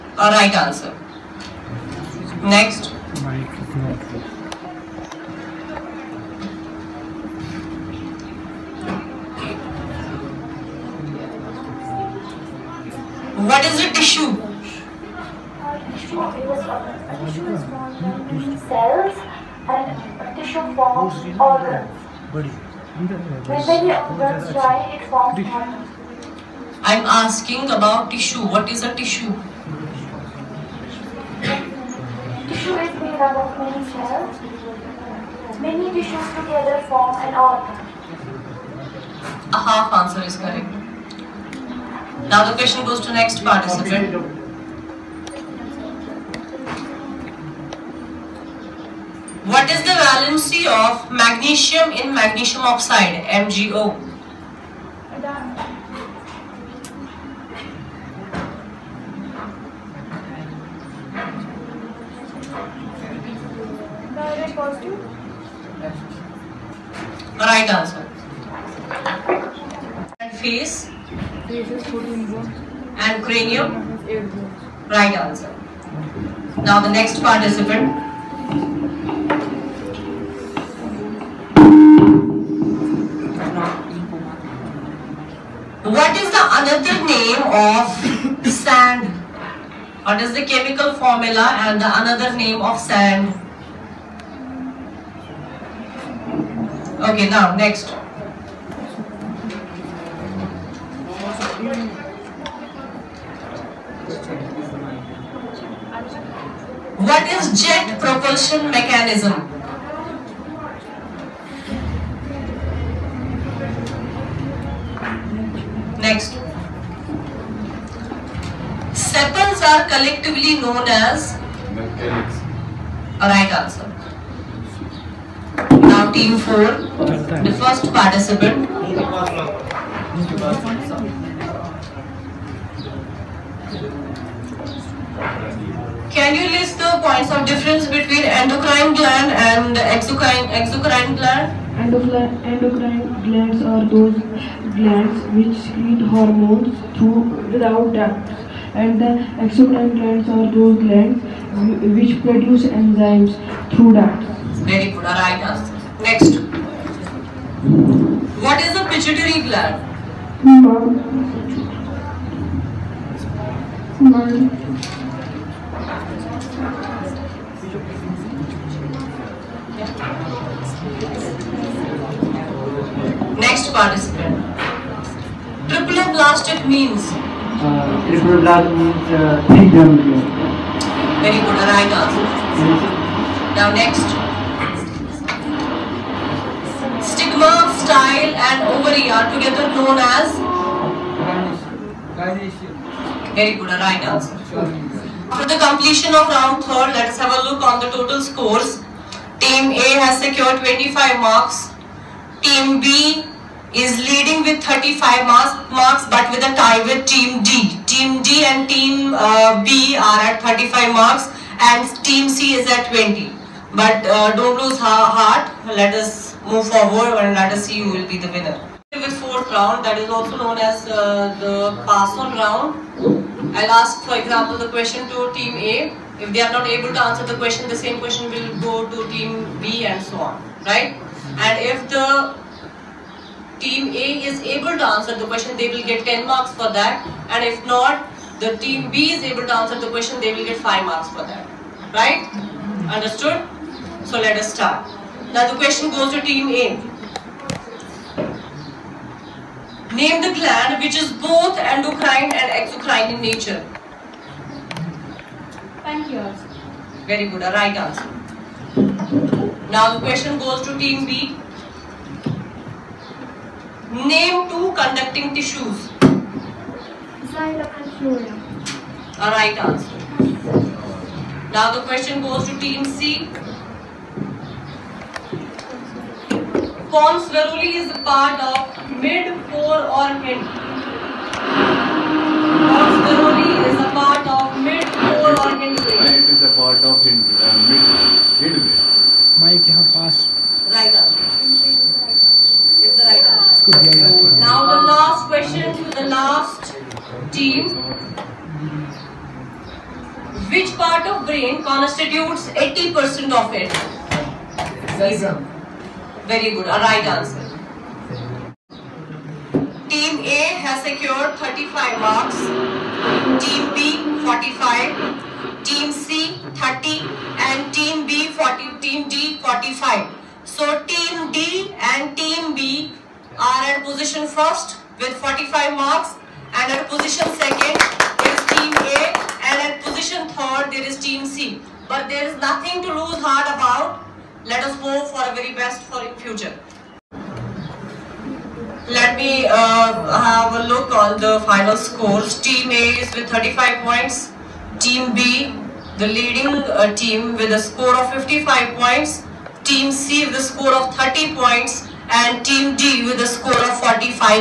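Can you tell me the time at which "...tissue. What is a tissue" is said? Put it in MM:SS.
00:28.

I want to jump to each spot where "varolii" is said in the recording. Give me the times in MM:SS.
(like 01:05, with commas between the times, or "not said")
04:37, 04:43.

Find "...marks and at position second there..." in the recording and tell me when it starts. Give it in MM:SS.
05:25.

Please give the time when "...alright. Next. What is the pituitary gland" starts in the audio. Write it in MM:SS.
02:35.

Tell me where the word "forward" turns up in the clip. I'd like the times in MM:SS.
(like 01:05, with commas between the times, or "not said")
03:36.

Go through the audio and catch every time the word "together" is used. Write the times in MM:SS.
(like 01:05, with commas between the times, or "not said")
00:36, 03:09.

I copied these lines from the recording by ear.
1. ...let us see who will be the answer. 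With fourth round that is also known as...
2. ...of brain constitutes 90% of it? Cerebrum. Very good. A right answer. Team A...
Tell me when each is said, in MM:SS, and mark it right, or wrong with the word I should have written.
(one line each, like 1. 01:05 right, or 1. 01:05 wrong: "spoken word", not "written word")
1. 03:37 wrong: "winner", not "answer"
2. 05:01 wrong: "80", not "90".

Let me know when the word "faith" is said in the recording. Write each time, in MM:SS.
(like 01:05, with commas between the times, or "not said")
not said.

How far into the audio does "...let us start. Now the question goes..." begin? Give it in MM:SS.
04:04.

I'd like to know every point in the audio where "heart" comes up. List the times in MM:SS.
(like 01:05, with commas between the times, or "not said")
03:34, 05:33.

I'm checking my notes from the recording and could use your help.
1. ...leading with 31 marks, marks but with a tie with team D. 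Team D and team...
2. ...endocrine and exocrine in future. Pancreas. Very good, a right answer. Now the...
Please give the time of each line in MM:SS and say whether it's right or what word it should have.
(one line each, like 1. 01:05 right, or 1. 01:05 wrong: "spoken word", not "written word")
1. 03:23 wrong: "35", not "31"
2. 04:11 wrong: "nature", not "future".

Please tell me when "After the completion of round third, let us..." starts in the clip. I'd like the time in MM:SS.
03:15.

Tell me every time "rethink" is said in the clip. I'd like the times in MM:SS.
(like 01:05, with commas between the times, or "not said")
not said.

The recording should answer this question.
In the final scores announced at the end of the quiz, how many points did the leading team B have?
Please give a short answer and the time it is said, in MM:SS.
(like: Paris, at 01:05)
55, at 05:47.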